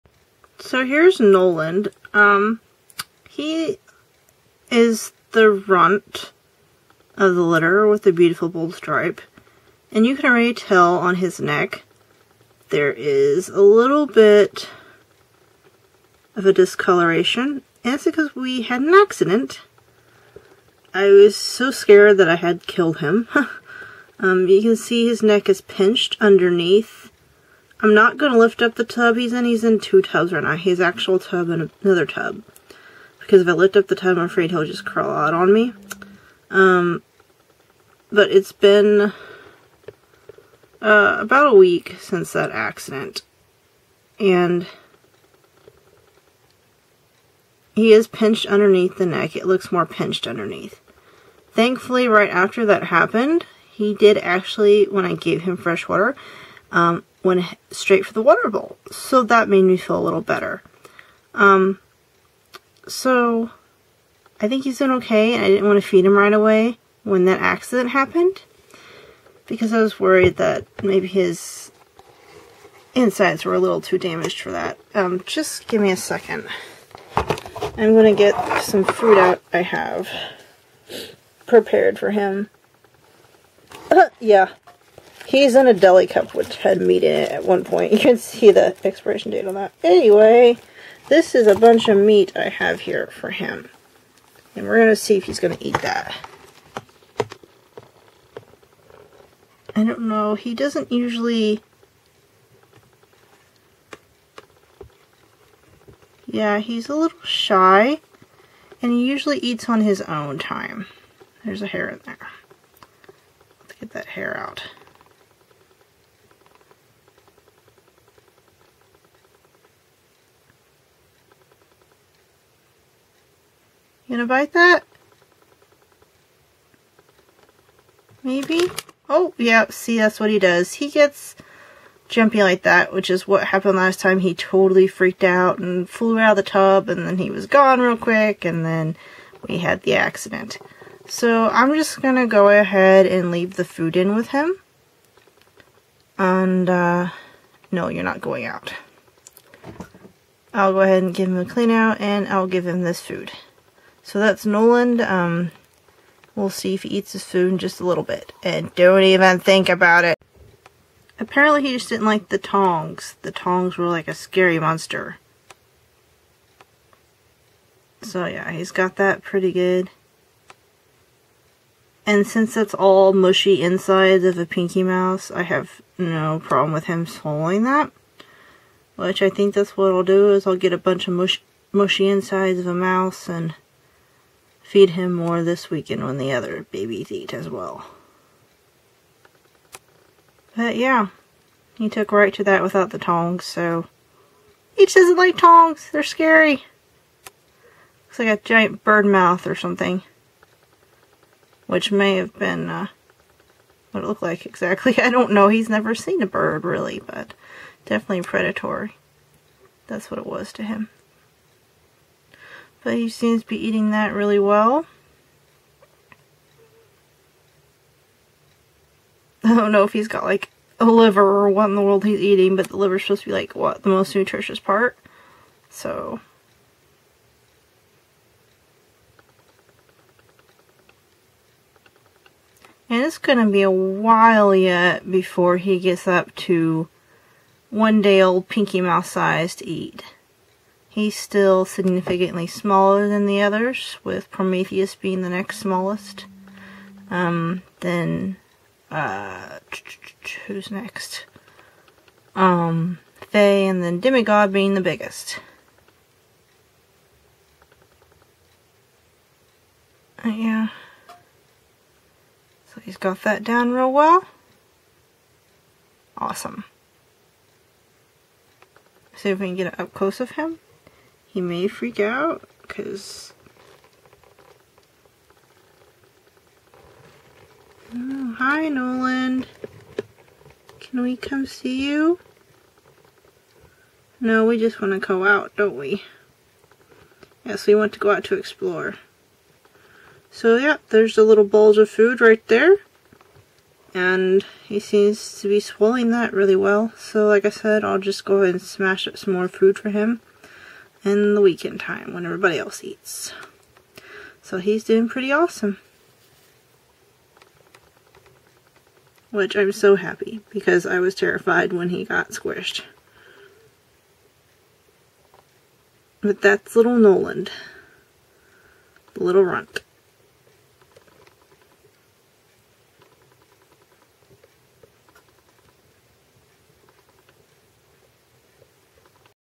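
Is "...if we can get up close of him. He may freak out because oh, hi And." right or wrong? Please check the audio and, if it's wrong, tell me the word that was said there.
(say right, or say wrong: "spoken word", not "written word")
wrong: "Noland", not "And".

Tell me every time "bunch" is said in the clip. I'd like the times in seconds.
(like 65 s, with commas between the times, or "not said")
91 s, 180 s.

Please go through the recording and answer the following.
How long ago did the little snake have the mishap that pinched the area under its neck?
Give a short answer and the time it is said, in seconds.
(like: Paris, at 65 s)
about a week, at 41 s.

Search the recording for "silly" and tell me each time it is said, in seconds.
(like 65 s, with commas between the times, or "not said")
not said.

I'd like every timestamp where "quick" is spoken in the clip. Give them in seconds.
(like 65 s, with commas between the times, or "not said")
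137 s.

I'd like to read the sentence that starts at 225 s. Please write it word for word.
So And it's going to be a while yet before he gets up to one day old Pinky Mouse size to eat.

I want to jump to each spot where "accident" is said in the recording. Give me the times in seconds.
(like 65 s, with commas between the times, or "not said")
18 s, 42 s, 67 s, 139 s.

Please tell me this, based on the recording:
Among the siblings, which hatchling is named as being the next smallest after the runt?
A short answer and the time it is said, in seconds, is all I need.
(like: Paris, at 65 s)
Prometheus, at 244 s.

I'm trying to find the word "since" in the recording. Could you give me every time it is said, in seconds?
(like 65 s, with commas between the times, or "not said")
41 s, 172 s.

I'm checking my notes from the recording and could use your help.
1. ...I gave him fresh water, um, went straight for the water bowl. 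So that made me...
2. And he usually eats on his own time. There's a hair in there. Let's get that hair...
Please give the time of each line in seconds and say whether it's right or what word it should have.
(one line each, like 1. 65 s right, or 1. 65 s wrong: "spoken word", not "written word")
1. 55 s right
2. 108 s right.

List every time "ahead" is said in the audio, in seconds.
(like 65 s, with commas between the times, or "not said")
142 s, 150 s, 298 s.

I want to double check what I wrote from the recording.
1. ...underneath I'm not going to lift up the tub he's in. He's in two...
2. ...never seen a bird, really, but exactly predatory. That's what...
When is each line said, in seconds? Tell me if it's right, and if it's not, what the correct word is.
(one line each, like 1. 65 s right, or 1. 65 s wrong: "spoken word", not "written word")
1. 26 s right
2. 205 s wrong: "definitely", not "exactly".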